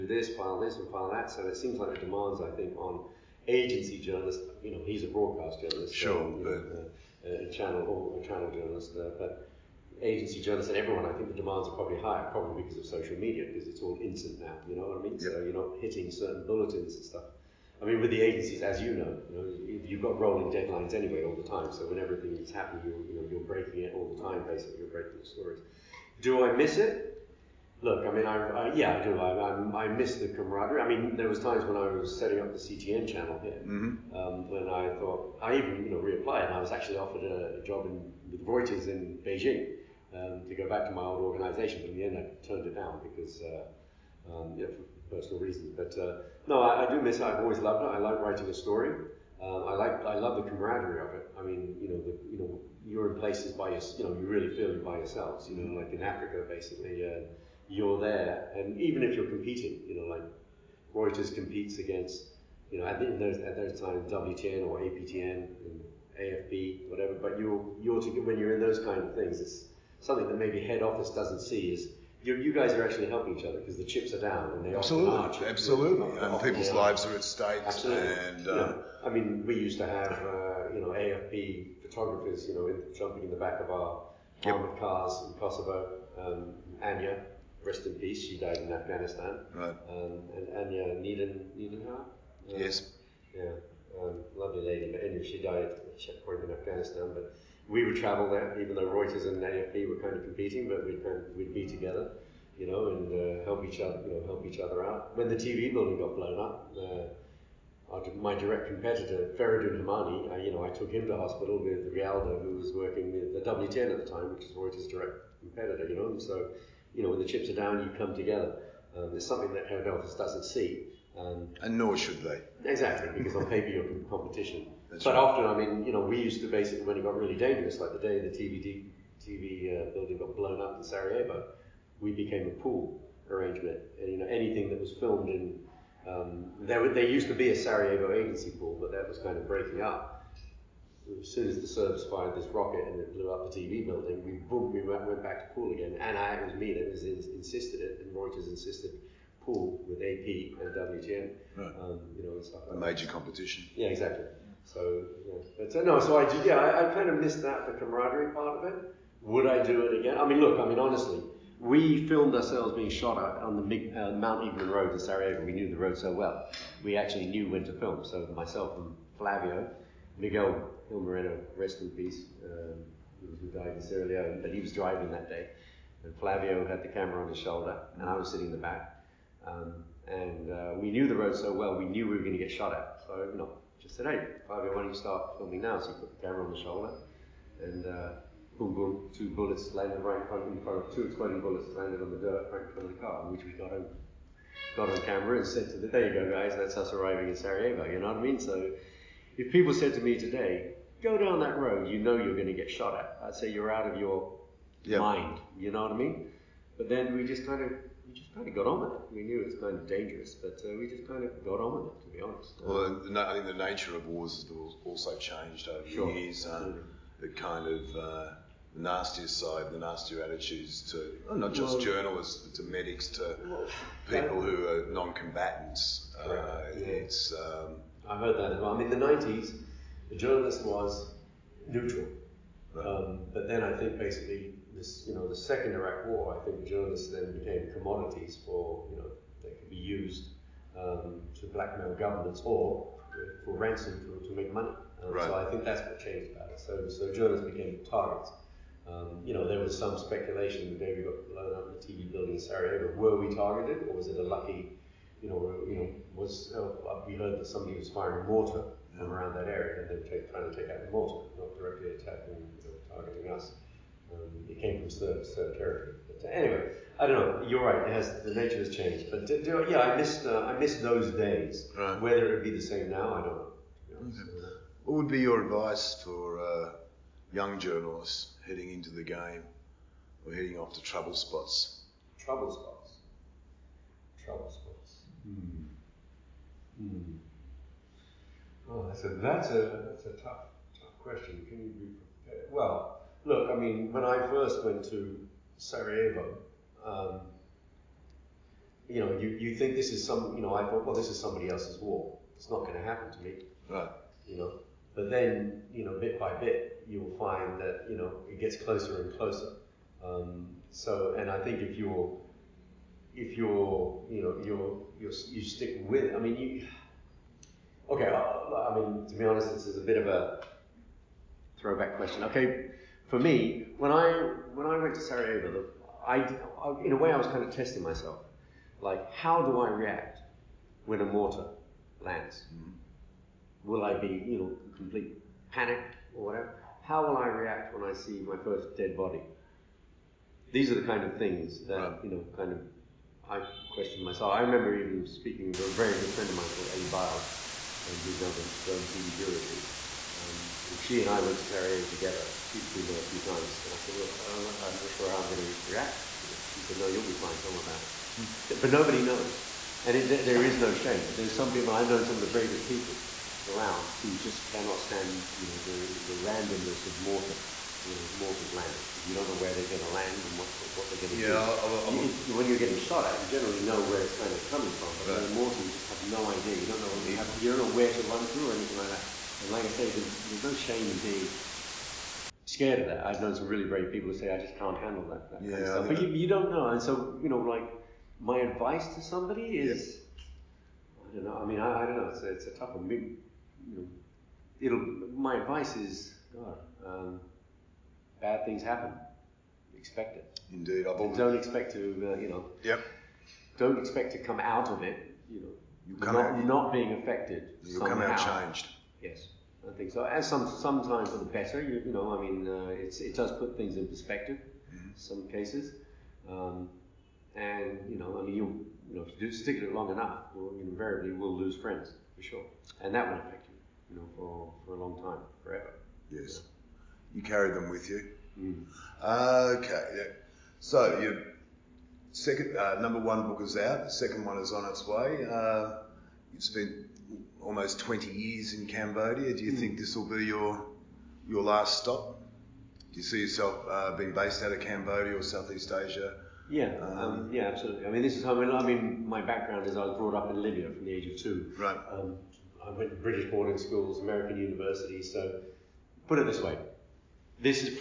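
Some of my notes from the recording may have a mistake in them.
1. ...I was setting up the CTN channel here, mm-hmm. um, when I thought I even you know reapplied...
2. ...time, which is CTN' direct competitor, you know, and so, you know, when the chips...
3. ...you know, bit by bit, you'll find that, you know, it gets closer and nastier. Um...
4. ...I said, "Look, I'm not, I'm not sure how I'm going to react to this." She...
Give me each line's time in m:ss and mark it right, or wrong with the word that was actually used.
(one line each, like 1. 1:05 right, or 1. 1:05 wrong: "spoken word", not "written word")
1. 0:31 right
2. 1:54 wrong: "Reuters", not "CTN"
3. 5:05 wrong: "closer", not "nastier"
4. 5:53 right.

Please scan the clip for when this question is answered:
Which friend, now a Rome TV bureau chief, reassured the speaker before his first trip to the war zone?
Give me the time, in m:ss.
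5:46.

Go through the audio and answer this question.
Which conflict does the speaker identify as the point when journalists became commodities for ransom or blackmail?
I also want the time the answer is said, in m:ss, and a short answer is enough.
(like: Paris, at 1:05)
Second Iraq War, at 3:55.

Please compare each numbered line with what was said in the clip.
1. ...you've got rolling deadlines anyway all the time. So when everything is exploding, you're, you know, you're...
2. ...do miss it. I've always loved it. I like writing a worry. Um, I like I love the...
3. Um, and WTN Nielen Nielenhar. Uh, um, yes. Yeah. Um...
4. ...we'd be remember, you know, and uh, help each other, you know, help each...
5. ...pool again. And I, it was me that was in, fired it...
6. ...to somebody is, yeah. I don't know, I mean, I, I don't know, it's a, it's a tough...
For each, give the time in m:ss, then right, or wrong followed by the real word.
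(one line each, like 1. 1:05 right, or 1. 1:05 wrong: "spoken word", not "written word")
1. 0:19 wrong: "happening", not "exploding"
2. 0:46 wrong: "story", not "worry"
3. 1:29 wrong: "Anya", not "WTN"
4. 1:41 wrong: "together", not "remember"
5. 2:25 wrong: "insisted", not "fired"
6. 6:28 right.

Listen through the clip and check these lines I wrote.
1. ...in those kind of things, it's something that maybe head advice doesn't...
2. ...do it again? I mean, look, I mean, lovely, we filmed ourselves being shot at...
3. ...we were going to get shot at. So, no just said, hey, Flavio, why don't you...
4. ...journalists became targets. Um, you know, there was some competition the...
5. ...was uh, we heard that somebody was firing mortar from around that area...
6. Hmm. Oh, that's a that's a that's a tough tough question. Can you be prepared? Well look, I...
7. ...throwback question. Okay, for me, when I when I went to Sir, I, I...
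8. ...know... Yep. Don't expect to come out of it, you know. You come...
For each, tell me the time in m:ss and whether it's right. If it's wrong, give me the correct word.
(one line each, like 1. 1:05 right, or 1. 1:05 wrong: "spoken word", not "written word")
1. 1:08 wrong: "office", not "advice"
2. 2:39 wrong: "honestly", not "lovely"
3. 3:02 right
4. 4:07 wrong: "speculation", not "competition"
5. 4:16 right
6. 4:46 right
7. 5:21 wrong: "Sarajevo", not "Sir"
8. 6:42 right.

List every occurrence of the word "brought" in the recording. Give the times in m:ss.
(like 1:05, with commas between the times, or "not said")
7:29.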